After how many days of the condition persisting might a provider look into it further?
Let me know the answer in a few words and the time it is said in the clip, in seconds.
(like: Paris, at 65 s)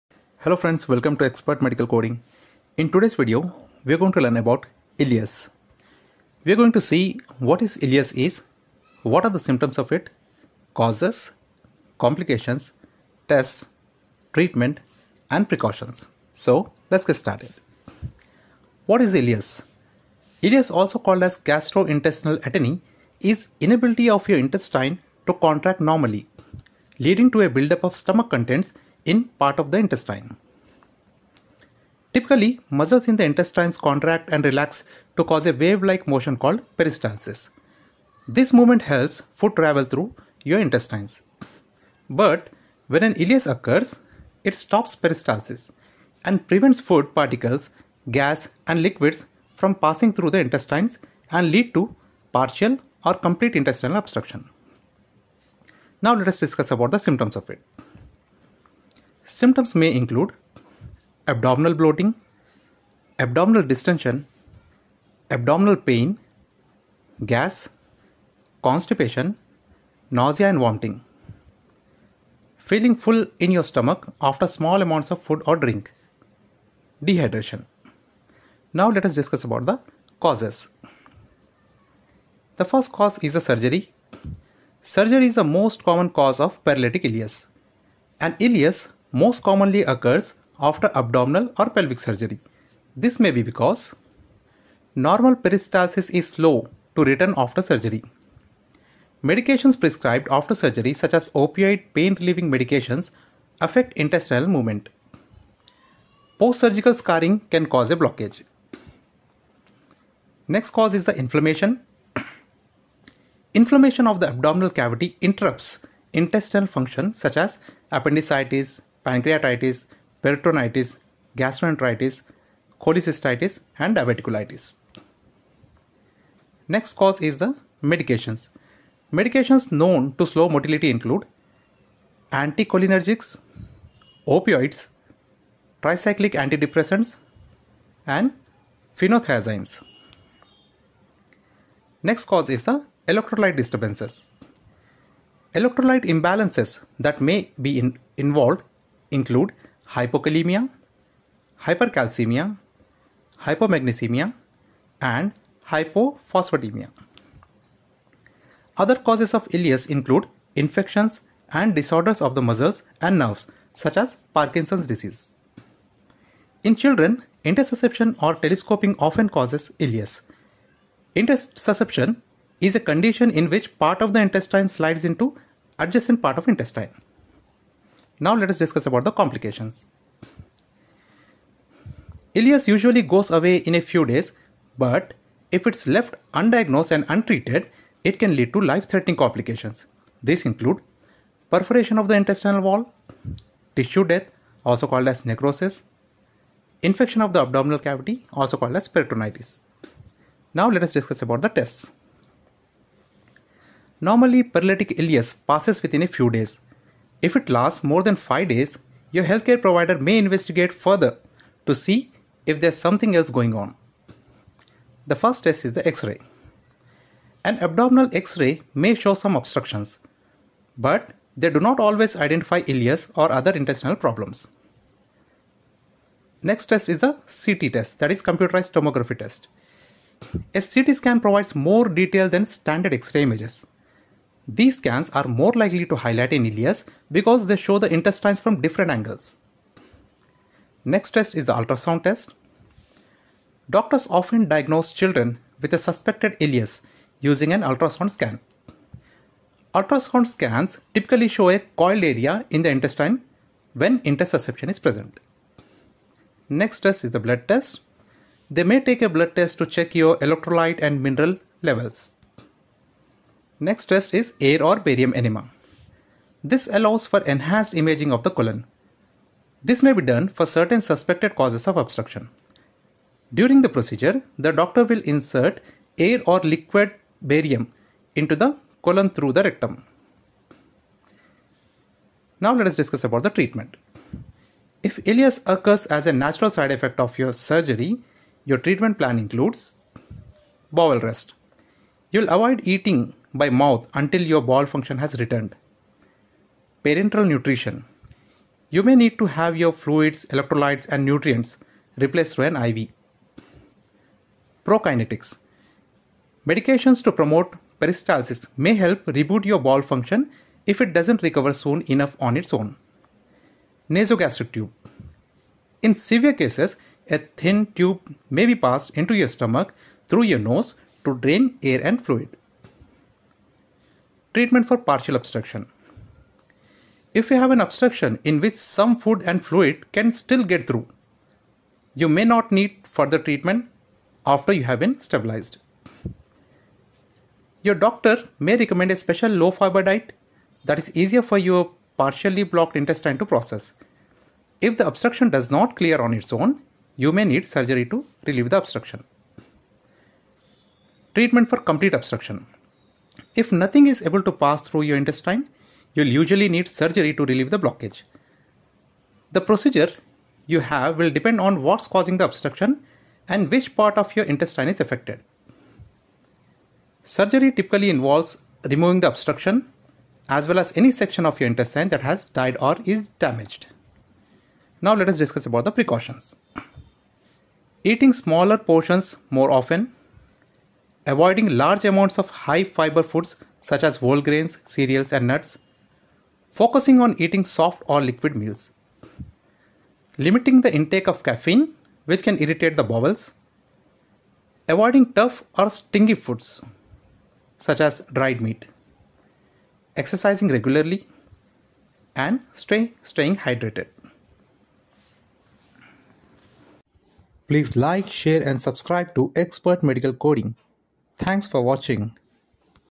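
5, at 208 s.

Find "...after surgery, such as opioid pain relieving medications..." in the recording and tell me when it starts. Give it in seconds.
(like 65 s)
100 s.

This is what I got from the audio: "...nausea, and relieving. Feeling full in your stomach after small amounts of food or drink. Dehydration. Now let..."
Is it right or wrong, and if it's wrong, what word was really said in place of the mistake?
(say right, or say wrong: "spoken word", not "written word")
wrong: "vomiting", not "relieving".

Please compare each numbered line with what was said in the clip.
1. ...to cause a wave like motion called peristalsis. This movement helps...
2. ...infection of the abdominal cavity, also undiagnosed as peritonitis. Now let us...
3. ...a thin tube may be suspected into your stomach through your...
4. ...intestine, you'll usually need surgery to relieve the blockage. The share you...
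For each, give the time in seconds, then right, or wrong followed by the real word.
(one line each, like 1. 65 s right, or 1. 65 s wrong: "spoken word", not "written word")
1. 35 s right
2. 196 s wrong: "called", not "undiagnosed"
3. 317 s wrong: "passed", not "suspected"
4. 354 s wrong: "procedure", not "share".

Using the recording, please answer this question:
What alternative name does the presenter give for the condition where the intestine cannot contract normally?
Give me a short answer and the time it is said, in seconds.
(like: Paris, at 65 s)
Gastrointestinal atony, at 21 s.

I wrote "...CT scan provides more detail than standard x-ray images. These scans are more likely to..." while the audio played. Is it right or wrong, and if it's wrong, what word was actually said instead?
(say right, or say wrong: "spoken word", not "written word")
right.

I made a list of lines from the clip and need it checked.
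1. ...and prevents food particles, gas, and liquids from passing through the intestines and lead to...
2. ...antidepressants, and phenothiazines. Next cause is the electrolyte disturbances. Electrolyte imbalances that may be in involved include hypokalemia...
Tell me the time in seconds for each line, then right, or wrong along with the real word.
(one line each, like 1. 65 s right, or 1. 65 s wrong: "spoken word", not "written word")
1. 46 s right
2. 136 s right.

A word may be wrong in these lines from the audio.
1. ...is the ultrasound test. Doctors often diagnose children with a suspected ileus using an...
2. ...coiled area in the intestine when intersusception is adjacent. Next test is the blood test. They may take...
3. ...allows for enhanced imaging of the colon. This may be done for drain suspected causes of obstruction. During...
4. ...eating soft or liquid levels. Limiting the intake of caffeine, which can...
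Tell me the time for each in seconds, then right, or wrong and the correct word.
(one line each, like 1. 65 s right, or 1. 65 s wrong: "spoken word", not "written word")
1. 241 s right
2. 251 s wrong: "present", not "adjacent"
3. 266 s wrong: "certain", not "drain"
4. 387 s wrong: "meals", not "levels".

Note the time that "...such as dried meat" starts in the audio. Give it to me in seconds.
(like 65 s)
397 s.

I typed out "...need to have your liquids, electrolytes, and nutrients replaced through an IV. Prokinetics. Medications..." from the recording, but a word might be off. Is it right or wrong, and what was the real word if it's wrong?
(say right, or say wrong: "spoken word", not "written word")
wrong: "fluids", not "liquids".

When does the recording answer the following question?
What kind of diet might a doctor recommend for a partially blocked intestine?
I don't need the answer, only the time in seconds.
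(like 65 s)
339 s.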